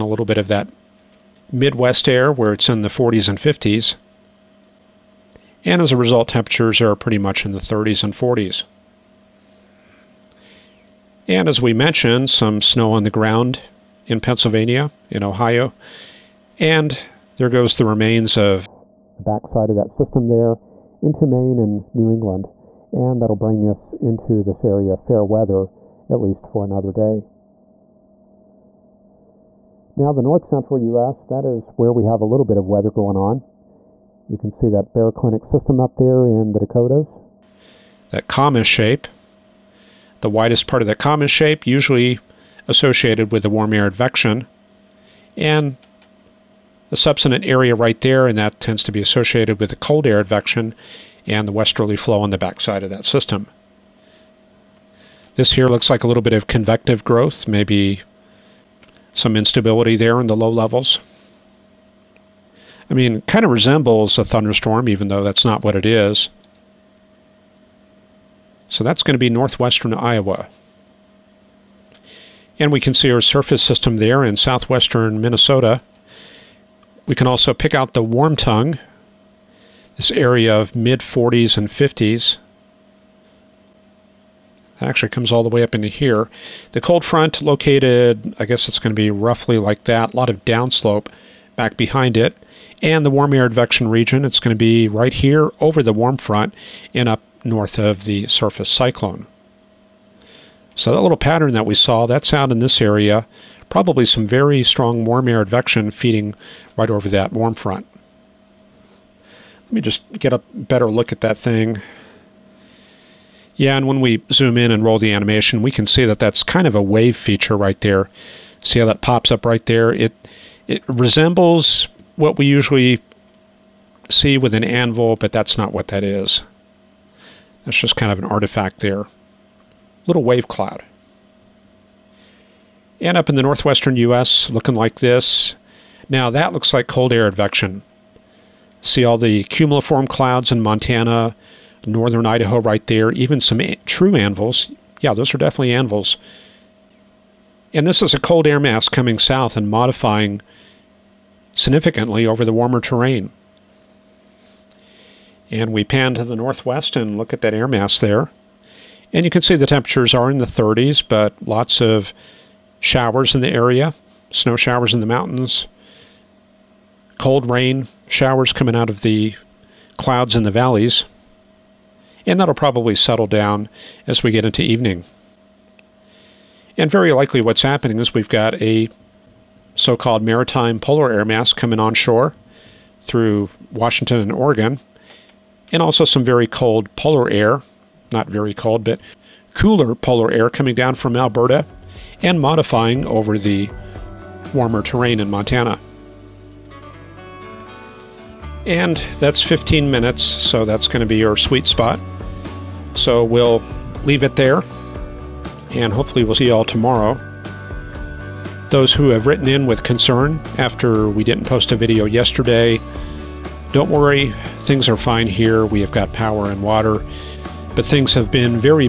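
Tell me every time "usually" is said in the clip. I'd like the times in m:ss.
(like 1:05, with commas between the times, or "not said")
0:41, 2:02.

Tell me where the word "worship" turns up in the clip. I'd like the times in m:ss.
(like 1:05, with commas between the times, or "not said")
not said.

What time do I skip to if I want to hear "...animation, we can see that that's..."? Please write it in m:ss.
1:55.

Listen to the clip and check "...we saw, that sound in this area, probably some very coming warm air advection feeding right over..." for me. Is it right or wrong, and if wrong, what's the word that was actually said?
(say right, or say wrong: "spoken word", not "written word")
wrong: "strong", not "coming".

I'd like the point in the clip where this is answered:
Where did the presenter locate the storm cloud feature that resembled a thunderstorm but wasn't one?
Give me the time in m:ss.
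1:09.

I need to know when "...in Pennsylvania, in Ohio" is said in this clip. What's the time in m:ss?
0:14.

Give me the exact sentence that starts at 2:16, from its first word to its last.
Now that looks like cold air advection.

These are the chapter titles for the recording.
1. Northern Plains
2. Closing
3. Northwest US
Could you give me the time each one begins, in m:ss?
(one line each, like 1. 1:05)
1. 0:27
2. 3:16
3. 2:11.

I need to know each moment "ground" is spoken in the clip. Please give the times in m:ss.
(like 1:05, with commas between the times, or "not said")
0:13.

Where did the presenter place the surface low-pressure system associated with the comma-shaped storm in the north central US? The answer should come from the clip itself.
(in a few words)
southwestern Minnesota.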